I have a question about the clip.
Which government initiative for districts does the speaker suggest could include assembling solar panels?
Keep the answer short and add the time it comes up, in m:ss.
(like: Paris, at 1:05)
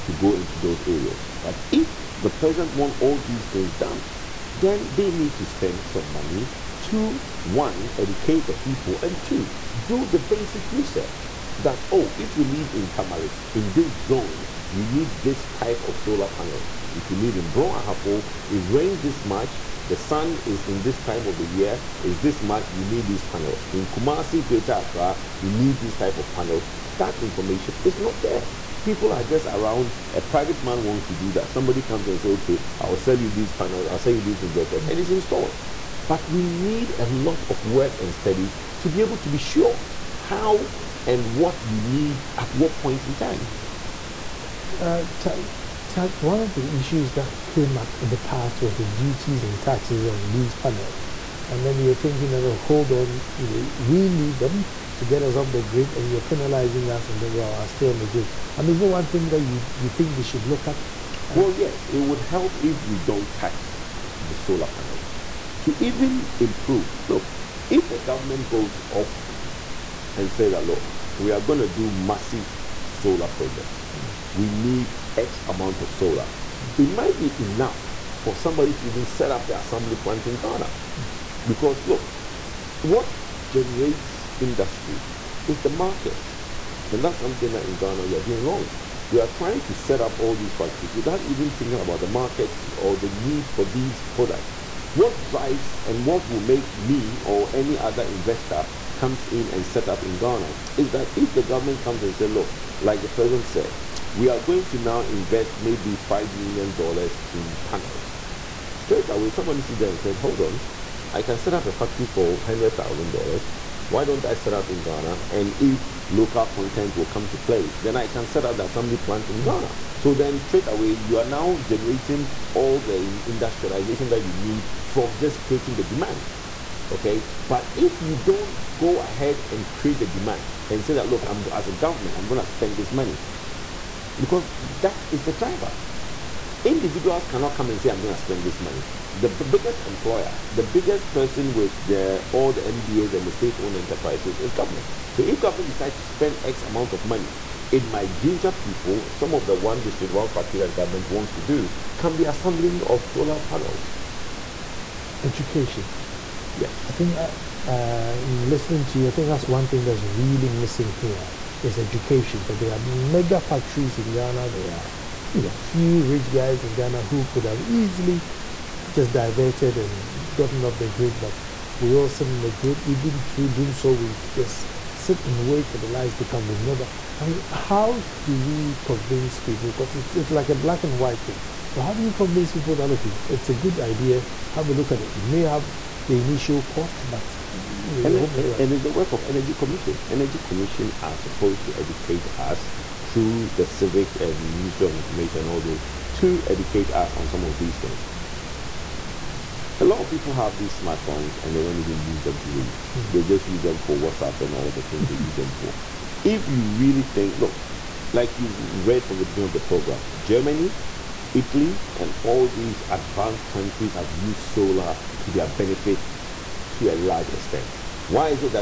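one district one factory, at 2:29.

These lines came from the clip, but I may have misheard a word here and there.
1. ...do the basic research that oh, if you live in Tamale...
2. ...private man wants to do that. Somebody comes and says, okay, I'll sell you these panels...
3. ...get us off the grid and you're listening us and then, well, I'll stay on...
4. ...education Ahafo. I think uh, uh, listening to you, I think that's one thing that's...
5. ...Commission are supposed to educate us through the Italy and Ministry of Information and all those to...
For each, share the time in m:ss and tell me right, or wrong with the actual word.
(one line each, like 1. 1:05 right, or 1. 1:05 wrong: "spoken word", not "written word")
1. 0:09 right
2. 0:30 right
3. 0:55 wrong: "penalizing", not "listening"
4. 2:35 wrong: "Yes", not "Ahafo"
5. 3:10 wrong: "Civic", not "Italy".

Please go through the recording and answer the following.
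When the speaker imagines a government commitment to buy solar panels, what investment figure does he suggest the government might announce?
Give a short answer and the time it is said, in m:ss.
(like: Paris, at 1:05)
$5 million, at 1:45.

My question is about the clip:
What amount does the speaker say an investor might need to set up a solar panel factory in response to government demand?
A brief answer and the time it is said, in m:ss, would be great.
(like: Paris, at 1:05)
$100,000, at 1:52.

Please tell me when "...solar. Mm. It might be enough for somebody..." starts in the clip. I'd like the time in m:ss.
1:15.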